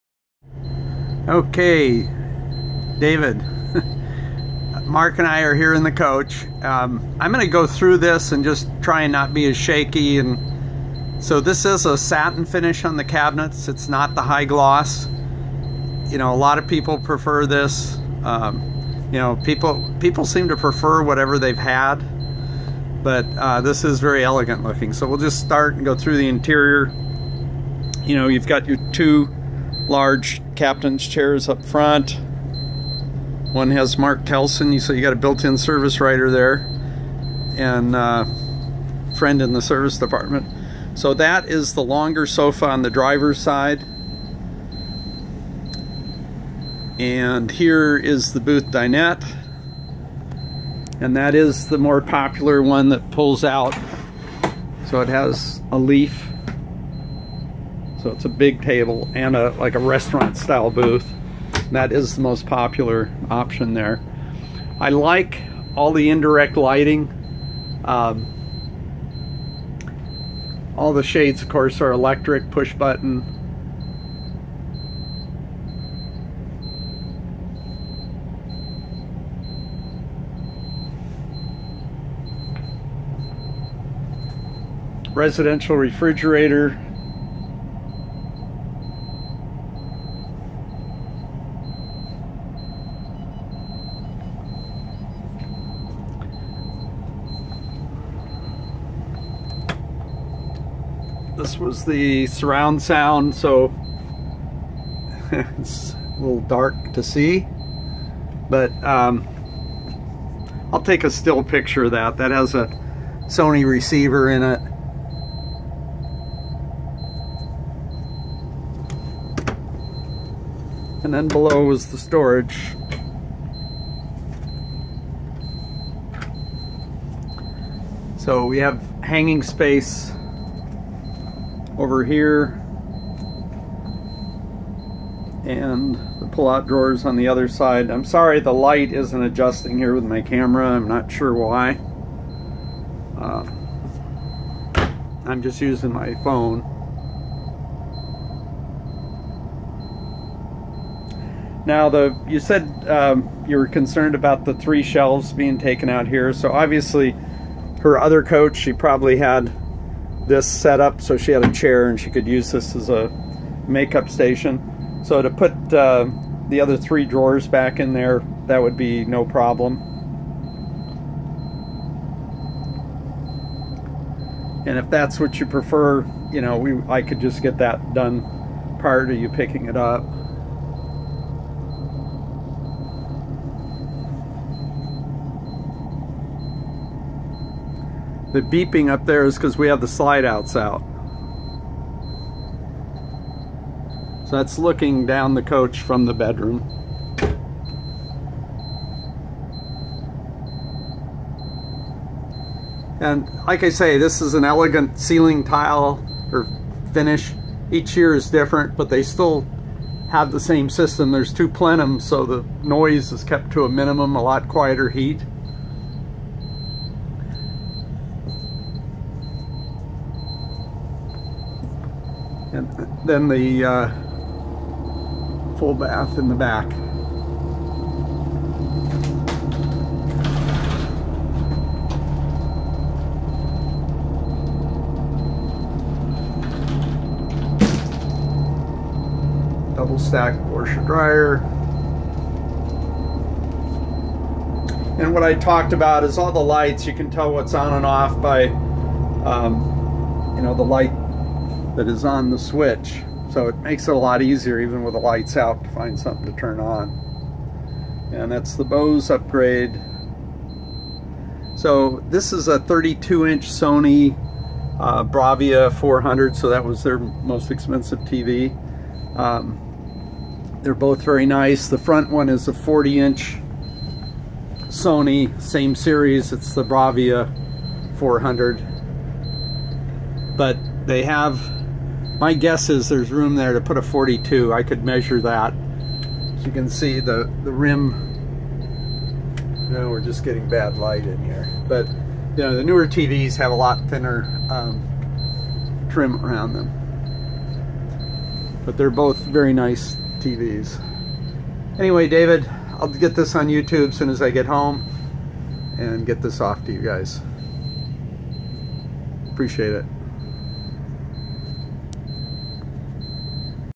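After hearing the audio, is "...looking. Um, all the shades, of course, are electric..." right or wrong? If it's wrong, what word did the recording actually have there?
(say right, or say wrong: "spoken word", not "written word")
wrong: "lighting", not "looking".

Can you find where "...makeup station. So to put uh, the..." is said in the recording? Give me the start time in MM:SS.
02:43.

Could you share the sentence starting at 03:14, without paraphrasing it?
So that's looking down the coach from the bedroom.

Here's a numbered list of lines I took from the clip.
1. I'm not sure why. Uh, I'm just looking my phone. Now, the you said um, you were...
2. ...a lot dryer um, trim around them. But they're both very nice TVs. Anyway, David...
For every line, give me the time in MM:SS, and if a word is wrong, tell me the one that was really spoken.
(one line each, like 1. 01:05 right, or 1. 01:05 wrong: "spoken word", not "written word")
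1. 02:20 wrong: "using", not "looking"
2. 04:53 wrong: "thinner", not "dryer".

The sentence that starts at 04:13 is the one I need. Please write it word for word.
So it makes it a lot easier, even with the lights out, to find something to turn on.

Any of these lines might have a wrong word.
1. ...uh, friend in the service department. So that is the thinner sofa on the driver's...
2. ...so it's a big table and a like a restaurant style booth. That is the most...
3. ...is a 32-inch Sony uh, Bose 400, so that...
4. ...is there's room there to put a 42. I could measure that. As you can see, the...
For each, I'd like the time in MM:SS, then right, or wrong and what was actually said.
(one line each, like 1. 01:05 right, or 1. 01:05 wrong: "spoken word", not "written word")
1. 00:37 wrong: "longer", not "thinner"
2. 00:58 right
3. 04:22 wrong: "Bravia", not "Bose"
4. 04:42 right.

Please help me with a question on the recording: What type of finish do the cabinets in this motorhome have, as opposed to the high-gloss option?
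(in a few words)
Satin.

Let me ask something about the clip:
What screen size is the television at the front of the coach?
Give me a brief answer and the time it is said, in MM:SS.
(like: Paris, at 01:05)
40 inches, at 04:32.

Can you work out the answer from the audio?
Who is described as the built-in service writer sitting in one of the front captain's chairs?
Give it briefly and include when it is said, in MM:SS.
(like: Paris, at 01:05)
Mark Kelson, at 00:33.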